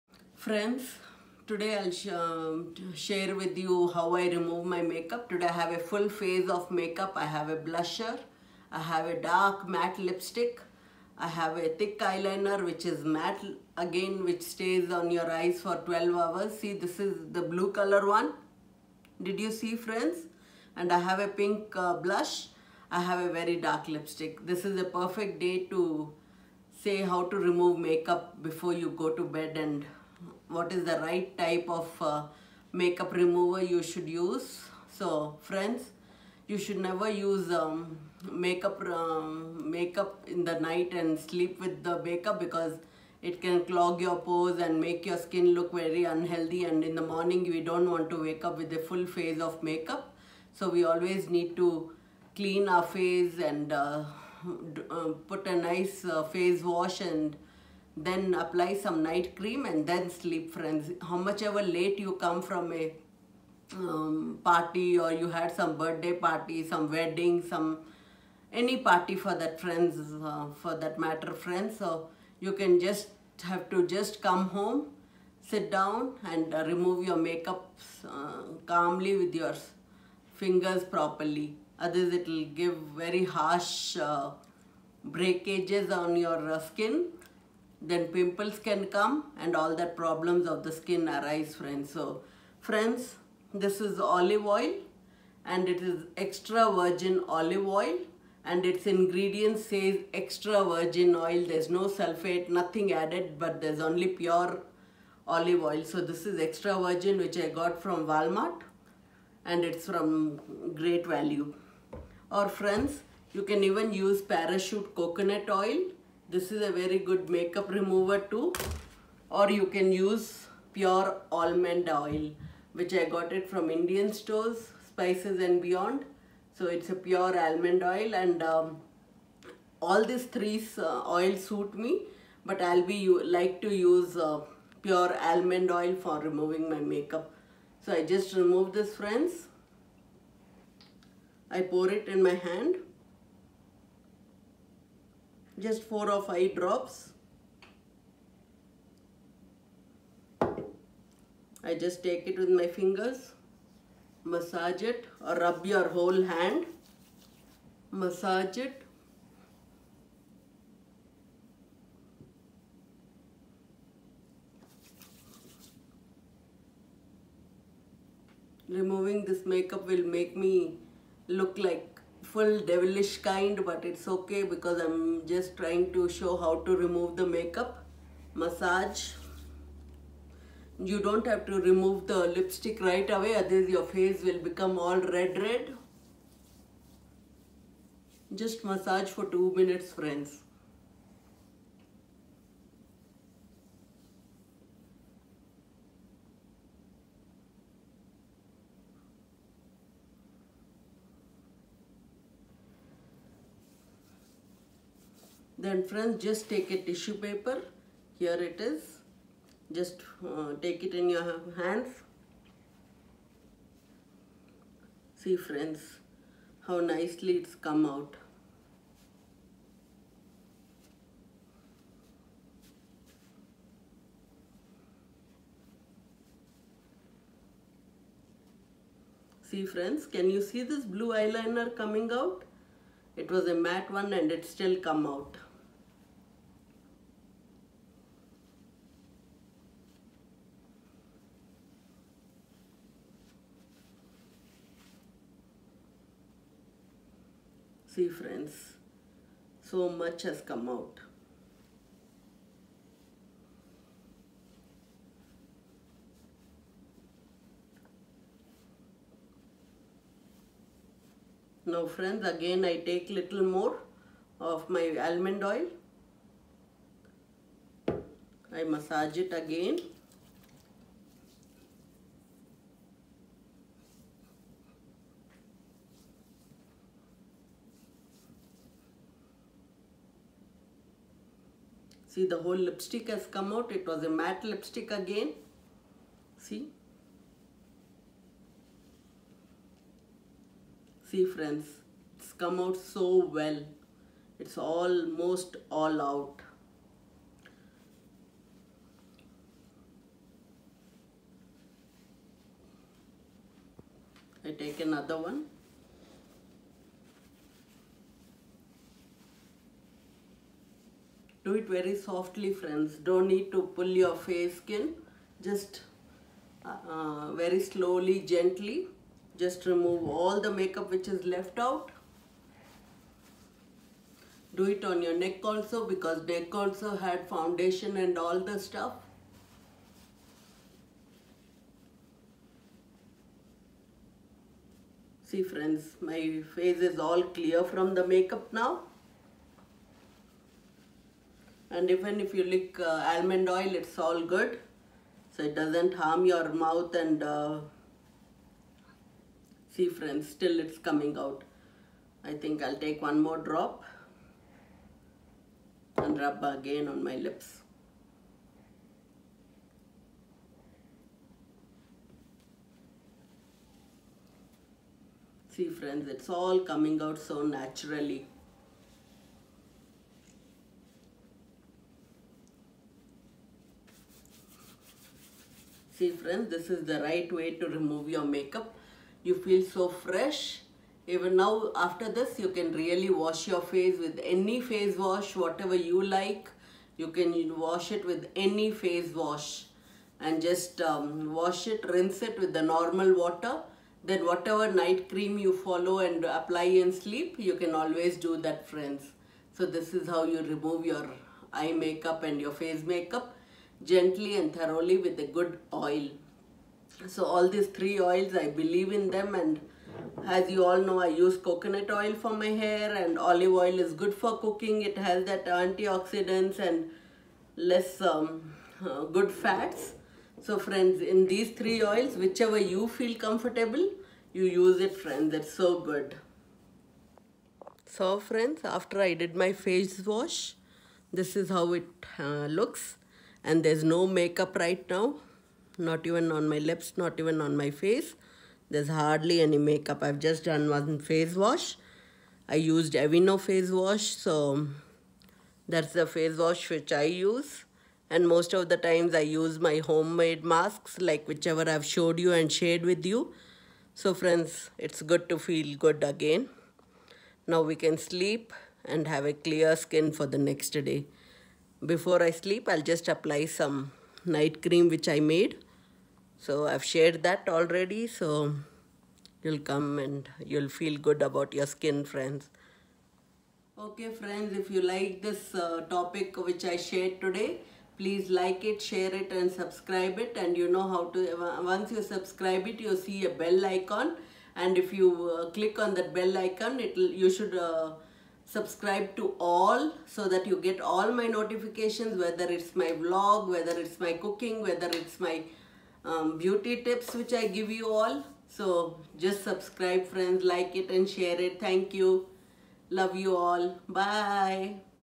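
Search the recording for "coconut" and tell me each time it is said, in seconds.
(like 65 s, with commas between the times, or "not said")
114 s, 411 s.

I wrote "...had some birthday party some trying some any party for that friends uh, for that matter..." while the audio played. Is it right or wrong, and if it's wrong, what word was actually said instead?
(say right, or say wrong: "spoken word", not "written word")
wrong: "wedding", not "trying".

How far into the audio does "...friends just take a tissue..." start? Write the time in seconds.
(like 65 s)
205 s.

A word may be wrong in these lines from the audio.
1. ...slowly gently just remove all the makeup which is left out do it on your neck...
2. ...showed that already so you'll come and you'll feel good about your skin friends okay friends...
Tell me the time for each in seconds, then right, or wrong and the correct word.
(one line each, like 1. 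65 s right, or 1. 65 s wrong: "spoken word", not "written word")
1. 317 s right
2. 466 s wrong: "shared", not "showed".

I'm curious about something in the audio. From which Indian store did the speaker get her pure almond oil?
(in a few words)
Spices and Beyond.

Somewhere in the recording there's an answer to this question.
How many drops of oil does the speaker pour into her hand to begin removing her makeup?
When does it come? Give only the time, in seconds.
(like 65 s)
145 s.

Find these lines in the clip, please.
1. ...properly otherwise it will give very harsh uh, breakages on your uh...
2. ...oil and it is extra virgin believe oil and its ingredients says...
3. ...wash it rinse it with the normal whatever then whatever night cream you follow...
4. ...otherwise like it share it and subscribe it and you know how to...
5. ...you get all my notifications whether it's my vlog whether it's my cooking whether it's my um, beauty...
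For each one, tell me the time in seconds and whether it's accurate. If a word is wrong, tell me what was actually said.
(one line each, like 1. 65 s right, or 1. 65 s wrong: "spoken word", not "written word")
1. 80 s right
2. 94 s wrong: "olive", not "believe"
3. 391 s wrong: "water", not "whatever"
4. 477 s wrong: "please", not "otherwise"
5. 490 s right.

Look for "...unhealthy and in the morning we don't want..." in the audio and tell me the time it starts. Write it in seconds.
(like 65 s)
46 s.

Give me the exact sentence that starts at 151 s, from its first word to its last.
I just take it with my fingers, massage it or rub your whole hand, massage it.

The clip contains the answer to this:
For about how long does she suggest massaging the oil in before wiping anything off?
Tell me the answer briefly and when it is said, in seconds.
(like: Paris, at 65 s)
2 minutes, at 189 s.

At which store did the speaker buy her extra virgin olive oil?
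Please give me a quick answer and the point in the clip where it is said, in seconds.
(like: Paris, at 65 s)
Walmart, at 108 s.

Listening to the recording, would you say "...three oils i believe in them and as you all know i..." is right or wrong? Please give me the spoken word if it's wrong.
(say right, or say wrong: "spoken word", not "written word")
right.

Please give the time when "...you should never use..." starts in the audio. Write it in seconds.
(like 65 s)
36 s.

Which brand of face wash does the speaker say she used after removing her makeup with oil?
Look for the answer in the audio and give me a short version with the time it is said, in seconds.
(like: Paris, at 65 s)
Aveeno, at 442 s.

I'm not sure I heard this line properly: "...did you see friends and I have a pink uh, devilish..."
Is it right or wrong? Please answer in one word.
wrong.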